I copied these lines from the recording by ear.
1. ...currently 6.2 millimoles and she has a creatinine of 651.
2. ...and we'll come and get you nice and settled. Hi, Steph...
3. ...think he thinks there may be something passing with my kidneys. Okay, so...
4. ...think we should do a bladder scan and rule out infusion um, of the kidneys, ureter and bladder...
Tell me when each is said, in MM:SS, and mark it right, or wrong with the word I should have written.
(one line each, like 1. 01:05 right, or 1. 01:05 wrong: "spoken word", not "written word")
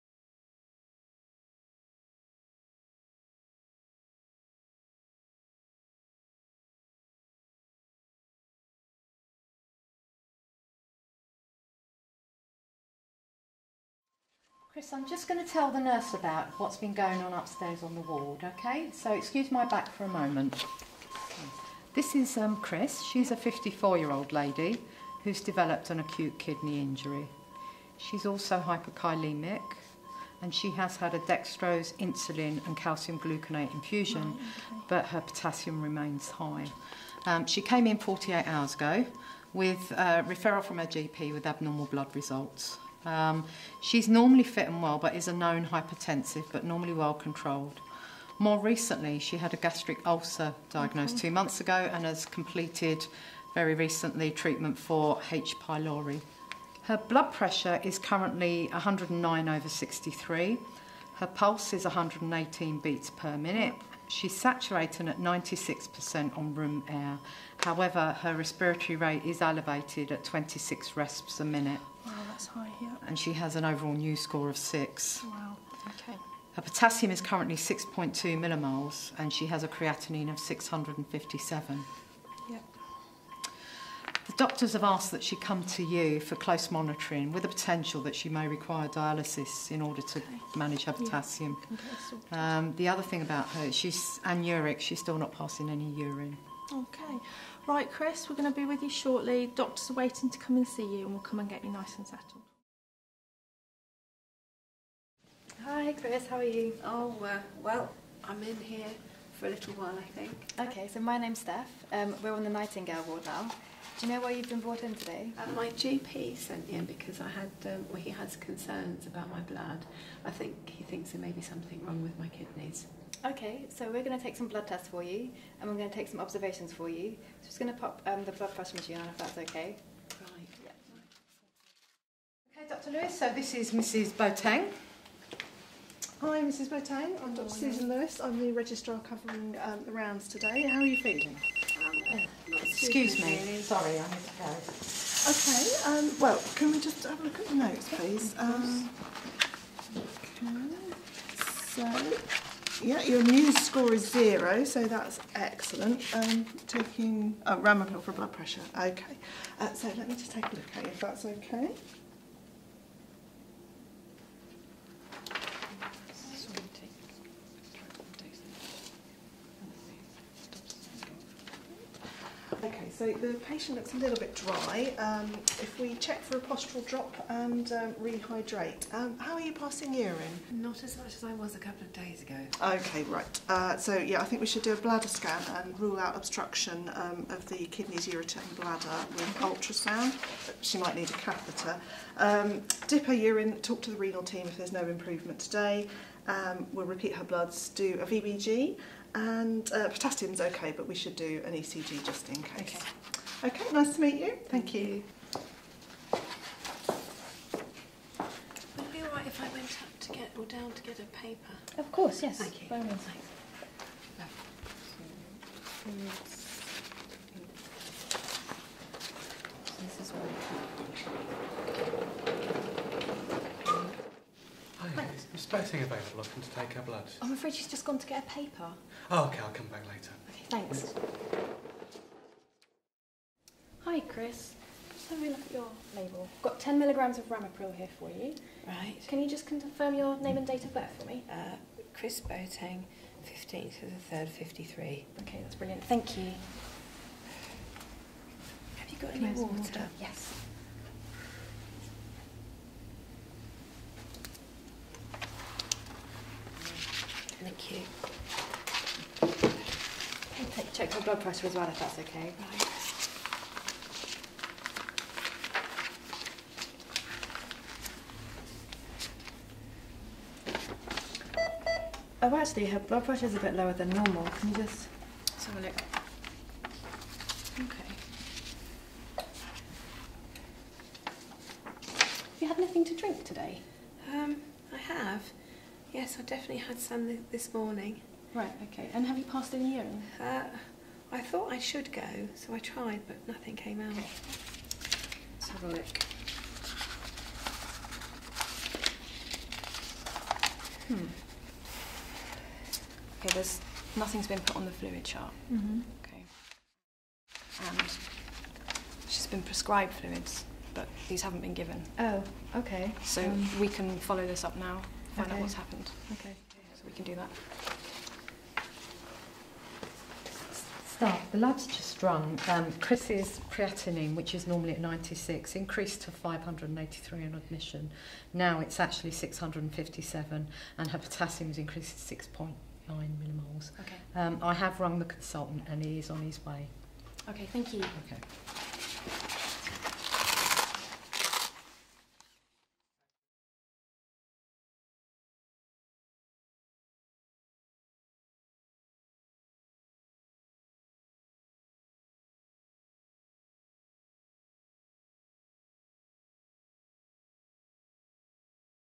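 1. 01:17 wrong: "657", not "651"
2. 01:41 wrong: "Chris", not "Steph"
3. 02:00 wrong: "wrong", not "passing"
4. 03:04 wrong: "obstruction", not "infusion".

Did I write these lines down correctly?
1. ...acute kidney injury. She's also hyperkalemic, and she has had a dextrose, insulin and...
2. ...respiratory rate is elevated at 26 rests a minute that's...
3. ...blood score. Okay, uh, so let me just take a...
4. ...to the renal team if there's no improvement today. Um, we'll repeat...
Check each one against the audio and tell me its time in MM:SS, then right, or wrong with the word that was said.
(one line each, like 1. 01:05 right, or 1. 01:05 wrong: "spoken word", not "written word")
1. 00:25 right
2. 01:08 right
3. 02:38 wrong: "pressure", not "score"
4. 03:13 right.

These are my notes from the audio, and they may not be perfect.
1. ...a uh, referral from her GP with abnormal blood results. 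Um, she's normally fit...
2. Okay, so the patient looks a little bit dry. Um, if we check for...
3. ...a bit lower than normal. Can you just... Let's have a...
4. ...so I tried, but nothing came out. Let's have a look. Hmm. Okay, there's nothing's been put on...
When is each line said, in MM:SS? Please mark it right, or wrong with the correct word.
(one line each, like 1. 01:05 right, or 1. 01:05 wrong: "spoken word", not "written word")
1. 00:39 right
2. 02:52 right
3. 04:33 right
4. 04:52 right.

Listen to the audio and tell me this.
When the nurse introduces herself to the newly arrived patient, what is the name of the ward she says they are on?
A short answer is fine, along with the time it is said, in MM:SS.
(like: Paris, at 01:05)
Nightingale, at 01:52.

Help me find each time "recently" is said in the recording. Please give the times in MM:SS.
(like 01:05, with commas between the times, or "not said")
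00:48, 00:53.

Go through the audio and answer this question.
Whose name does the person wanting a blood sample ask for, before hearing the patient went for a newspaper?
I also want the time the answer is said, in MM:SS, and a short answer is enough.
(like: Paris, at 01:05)
Blessing, at 03:45.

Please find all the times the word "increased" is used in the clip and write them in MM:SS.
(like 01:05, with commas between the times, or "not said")
05:25, 05:31.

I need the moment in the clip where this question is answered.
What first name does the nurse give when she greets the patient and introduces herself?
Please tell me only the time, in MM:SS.
01:51.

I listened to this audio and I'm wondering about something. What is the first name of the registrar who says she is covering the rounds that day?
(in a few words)
Susan.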